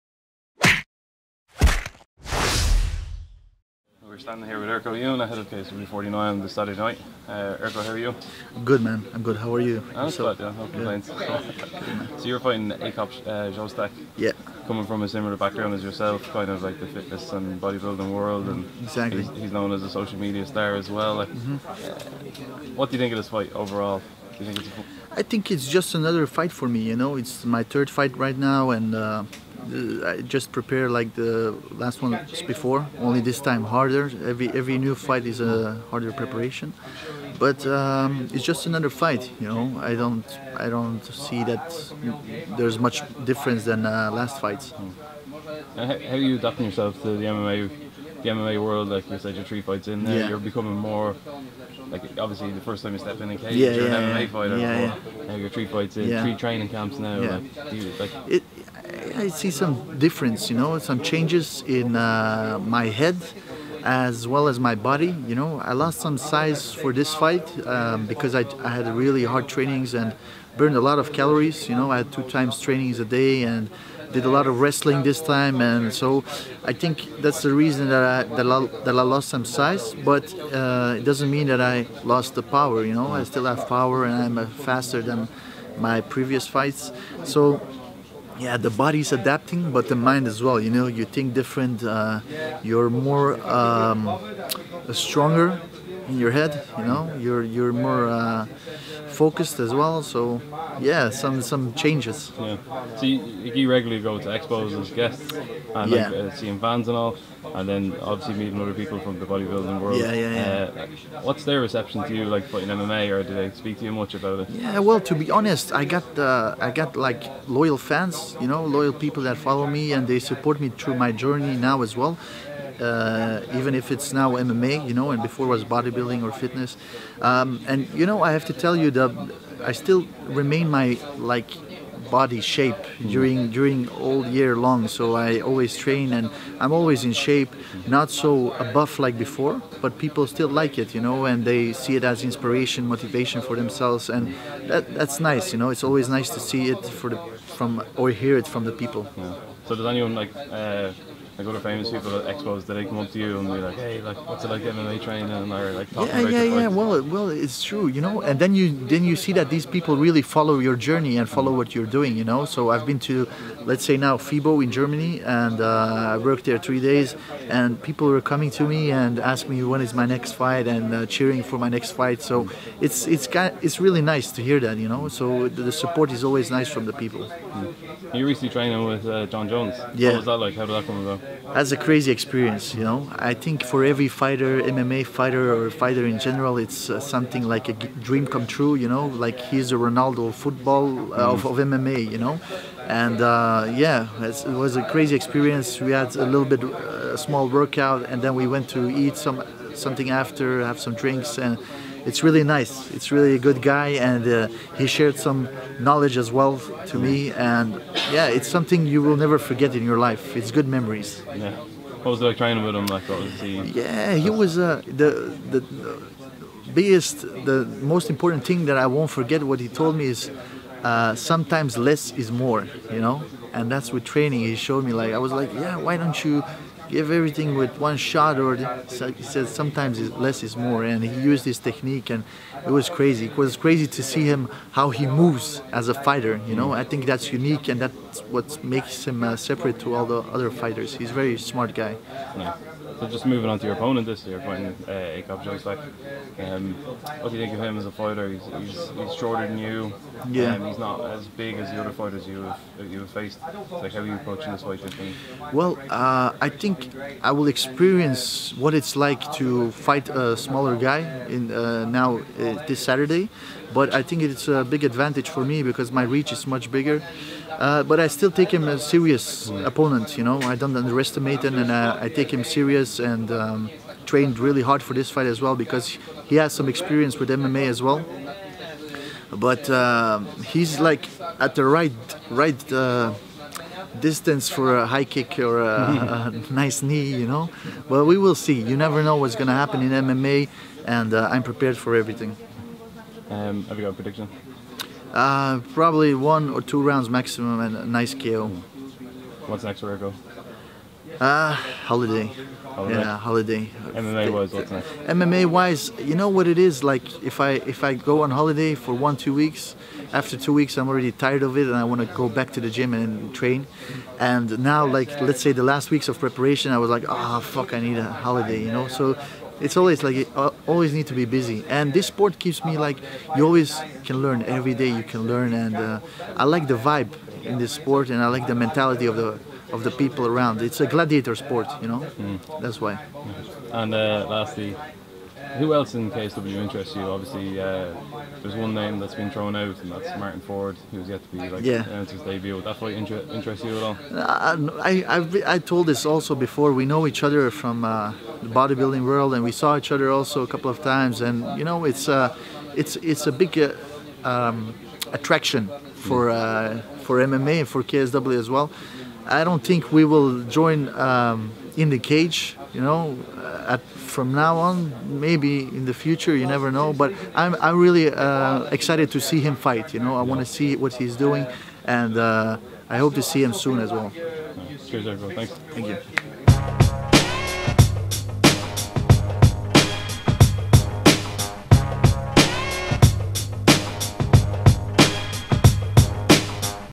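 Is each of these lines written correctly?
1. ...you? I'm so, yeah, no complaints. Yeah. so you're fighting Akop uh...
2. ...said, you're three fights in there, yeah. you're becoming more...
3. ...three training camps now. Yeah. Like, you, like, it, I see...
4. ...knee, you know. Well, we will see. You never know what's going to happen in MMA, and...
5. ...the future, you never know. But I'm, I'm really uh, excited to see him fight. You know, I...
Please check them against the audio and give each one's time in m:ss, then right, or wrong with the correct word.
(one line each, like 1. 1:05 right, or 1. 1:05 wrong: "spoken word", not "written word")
1. 0:09 right
2. 0:49 right
3. 0:56 right
4. 4:46 right
5. 6:05 right.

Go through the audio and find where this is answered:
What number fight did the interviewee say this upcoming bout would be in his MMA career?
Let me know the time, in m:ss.
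0:27.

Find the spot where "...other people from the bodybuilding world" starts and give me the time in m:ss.
1:48.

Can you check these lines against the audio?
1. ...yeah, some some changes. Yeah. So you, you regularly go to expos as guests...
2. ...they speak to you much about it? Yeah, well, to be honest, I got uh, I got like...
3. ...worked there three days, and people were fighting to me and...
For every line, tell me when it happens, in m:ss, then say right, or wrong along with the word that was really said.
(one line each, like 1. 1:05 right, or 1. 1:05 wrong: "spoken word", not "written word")
1. 1:40 right
2. 1:53 right
3. 2:46 wrong: "coming", not "fighting".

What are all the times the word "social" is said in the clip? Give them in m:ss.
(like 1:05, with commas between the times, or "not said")
0:19.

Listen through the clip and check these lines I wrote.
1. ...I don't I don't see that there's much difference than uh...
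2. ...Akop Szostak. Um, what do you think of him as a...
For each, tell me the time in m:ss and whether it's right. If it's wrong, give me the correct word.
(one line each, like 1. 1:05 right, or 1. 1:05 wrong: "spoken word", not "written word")
1. 0:39 right
2. 4:04 right.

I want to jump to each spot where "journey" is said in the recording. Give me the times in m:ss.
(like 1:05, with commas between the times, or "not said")
2:01, 2:40.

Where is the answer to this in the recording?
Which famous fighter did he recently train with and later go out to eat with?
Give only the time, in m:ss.
2:59.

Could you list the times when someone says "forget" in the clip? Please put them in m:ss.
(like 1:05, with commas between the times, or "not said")
3:29, 3:39.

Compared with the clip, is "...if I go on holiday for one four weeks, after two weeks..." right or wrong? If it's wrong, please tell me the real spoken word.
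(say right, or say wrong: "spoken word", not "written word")
wrong: "two", not "four".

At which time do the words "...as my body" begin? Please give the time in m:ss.
1:04.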